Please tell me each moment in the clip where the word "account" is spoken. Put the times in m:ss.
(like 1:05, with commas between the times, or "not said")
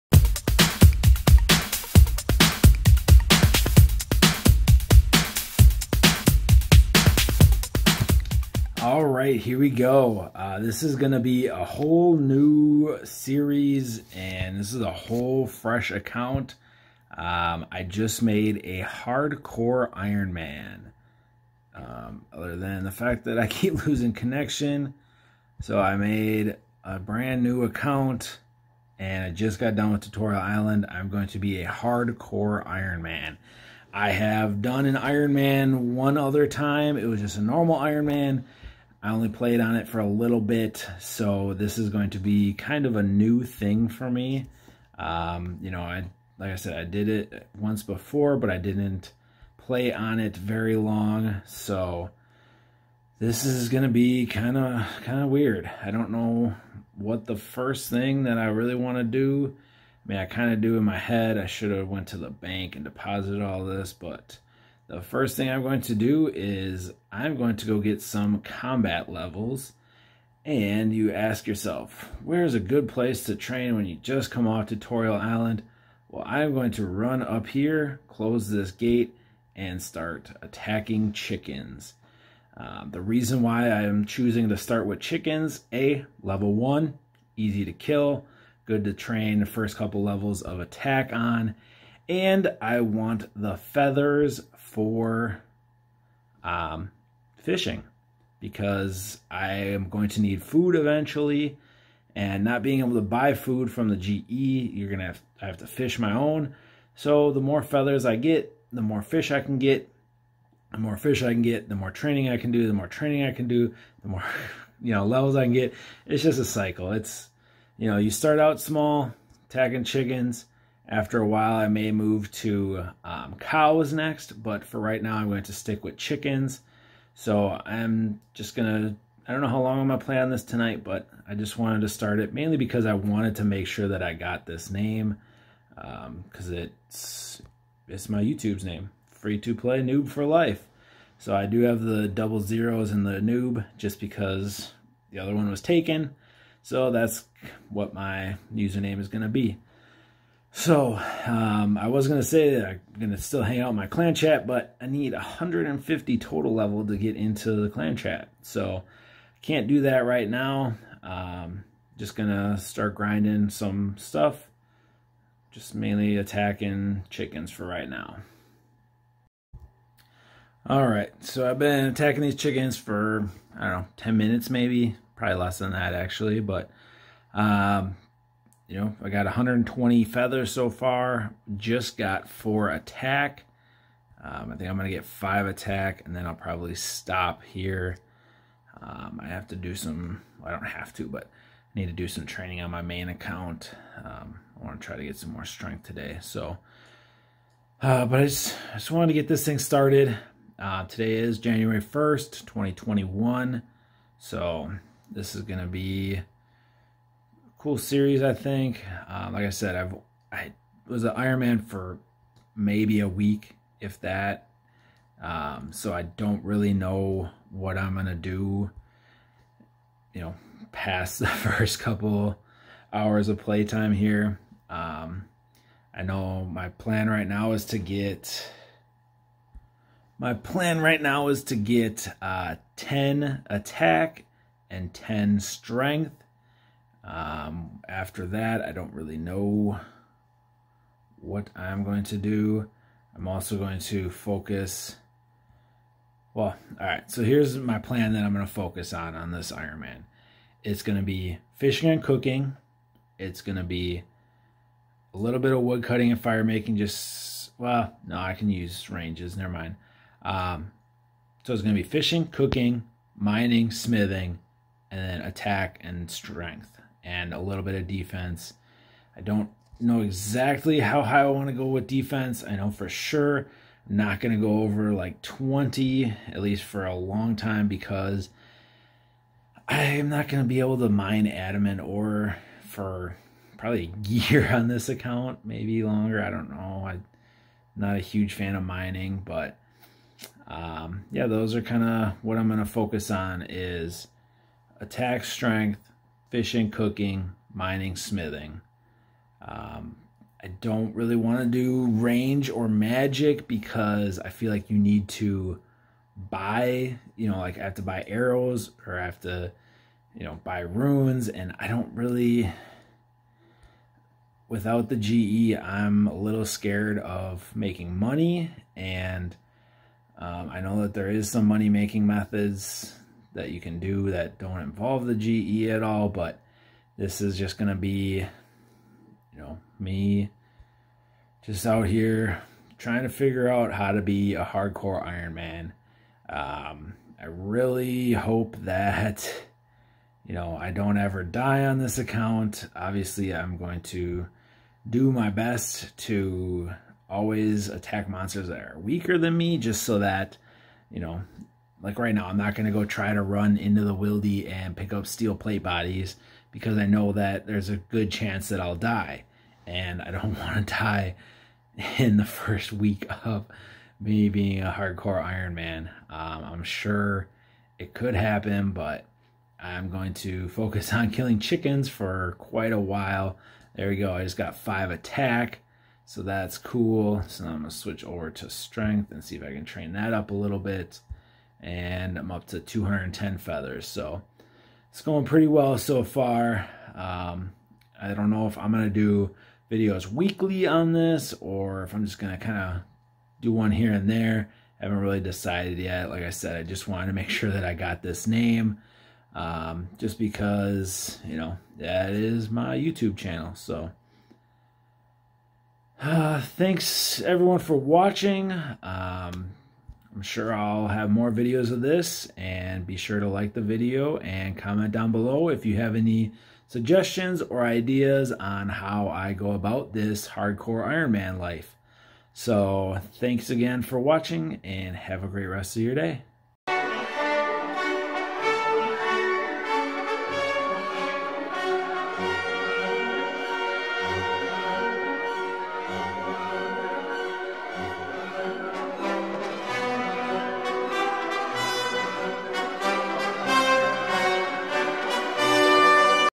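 0:15, 0:27, 3:13, 4:44, 5:41.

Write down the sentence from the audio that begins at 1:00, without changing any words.
I mean, I kind of do in my head.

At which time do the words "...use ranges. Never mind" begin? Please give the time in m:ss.
4:18.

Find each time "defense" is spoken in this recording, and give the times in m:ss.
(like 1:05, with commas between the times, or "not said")
4:27, 4:31.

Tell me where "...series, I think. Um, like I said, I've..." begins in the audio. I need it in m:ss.
3:27.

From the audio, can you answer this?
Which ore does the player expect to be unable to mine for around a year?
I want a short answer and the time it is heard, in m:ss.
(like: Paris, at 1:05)
Adamant, at 4:41.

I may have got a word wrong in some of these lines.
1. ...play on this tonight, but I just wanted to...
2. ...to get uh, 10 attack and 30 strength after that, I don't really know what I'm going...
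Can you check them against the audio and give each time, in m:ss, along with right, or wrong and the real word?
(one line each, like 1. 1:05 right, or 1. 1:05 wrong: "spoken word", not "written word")
1. 2:10 right
2. 3:51 wrong: "10", not "30".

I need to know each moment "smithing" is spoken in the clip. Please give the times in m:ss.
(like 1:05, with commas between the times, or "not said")
4:23, 4:57.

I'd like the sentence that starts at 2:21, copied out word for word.
So I do have the double zeros and the noob just because the other one was taken.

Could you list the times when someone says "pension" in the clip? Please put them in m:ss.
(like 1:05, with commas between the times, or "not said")
not said.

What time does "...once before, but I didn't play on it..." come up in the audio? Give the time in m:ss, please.
0:47.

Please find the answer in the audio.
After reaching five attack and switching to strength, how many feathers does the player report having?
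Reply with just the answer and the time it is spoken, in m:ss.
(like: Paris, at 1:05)
210, at 6:22.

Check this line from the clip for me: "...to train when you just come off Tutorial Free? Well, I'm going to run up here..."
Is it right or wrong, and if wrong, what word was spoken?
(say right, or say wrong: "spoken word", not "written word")
wrong: "Island", not "Free".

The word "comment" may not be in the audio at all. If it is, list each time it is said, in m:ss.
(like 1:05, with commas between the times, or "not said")
6:54.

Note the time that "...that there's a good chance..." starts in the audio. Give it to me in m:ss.
5:57.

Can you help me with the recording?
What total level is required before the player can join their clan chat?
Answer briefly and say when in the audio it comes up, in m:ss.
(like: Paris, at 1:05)
150, at 2:35.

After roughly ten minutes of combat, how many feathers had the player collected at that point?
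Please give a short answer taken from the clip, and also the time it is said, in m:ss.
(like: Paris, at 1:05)
120, at 2:59.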